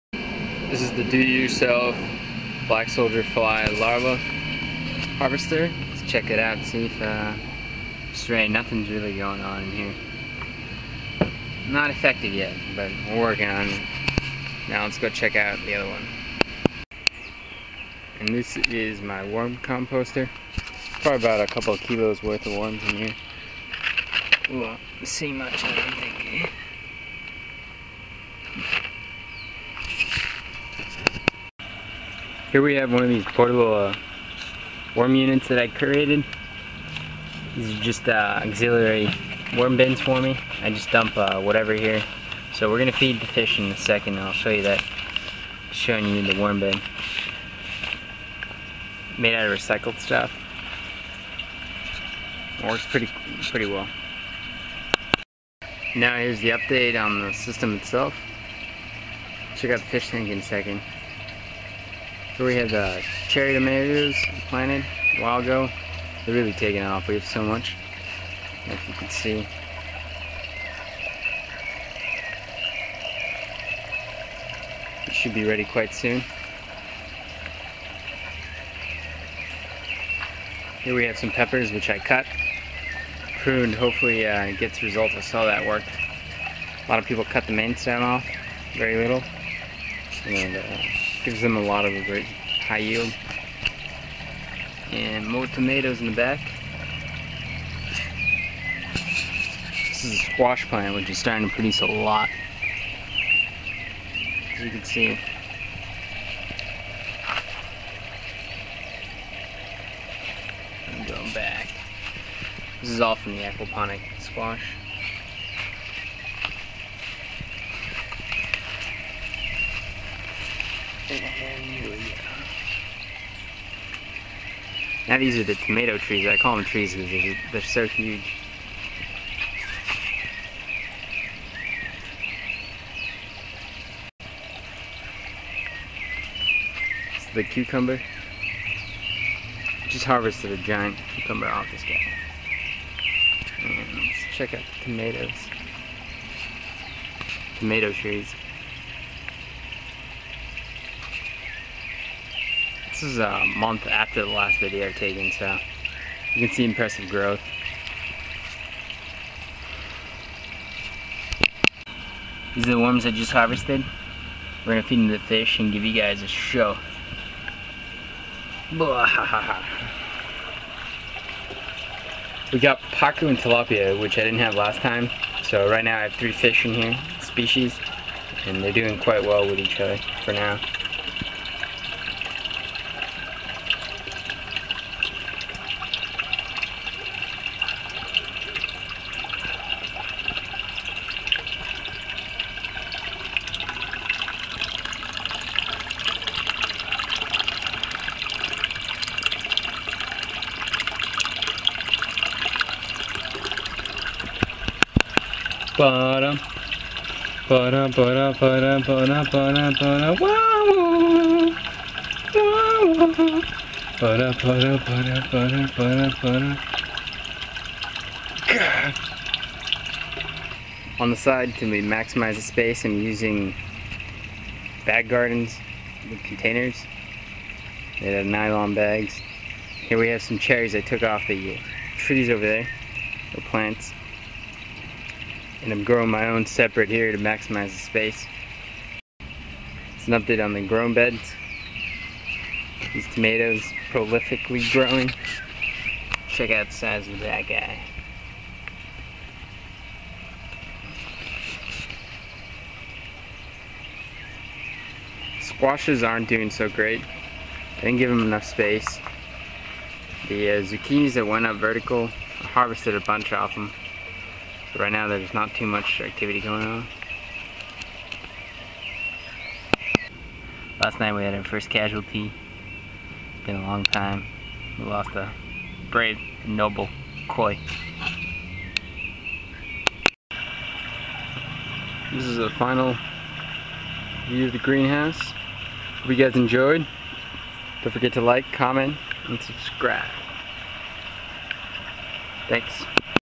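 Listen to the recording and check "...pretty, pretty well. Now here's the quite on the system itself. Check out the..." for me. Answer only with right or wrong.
wrong.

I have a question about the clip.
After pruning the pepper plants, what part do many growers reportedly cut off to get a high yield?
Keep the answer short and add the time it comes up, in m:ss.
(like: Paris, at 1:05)
main stem, at 1:27.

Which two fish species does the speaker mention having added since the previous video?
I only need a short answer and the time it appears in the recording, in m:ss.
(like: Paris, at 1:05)
pacu and tilapia, at 2:52.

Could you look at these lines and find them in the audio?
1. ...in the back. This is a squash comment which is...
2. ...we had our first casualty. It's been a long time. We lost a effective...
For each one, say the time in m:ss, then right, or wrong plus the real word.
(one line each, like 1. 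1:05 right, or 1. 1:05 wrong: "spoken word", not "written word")
1. 1:36 wrong: "plant", not "comment"
2. 4:31 wrong: "brave", not "effective".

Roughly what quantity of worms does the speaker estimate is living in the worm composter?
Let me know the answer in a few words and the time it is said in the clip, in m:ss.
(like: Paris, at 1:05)
a couple of kilos, at 0:21.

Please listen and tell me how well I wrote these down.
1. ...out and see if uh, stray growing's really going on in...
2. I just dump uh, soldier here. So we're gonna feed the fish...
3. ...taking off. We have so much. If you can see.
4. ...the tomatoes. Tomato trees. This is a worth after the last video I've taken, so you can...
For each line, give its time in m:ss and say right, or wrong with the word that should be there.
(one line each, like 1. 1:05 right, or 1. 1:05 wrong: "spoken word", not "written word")
1. 0:06 wrong: "nothing", not "growing"
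2. 0:40 wrong: "whatever", not "soldier"
3. 1:06 right
4. 2:24 wrong: "month", not "worth".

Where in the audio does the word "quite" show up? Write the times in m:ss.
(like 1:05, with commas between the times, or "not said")
1:15, 2:58.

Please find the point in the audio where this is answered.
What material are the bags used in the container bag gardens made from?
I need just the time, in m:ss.
3:48.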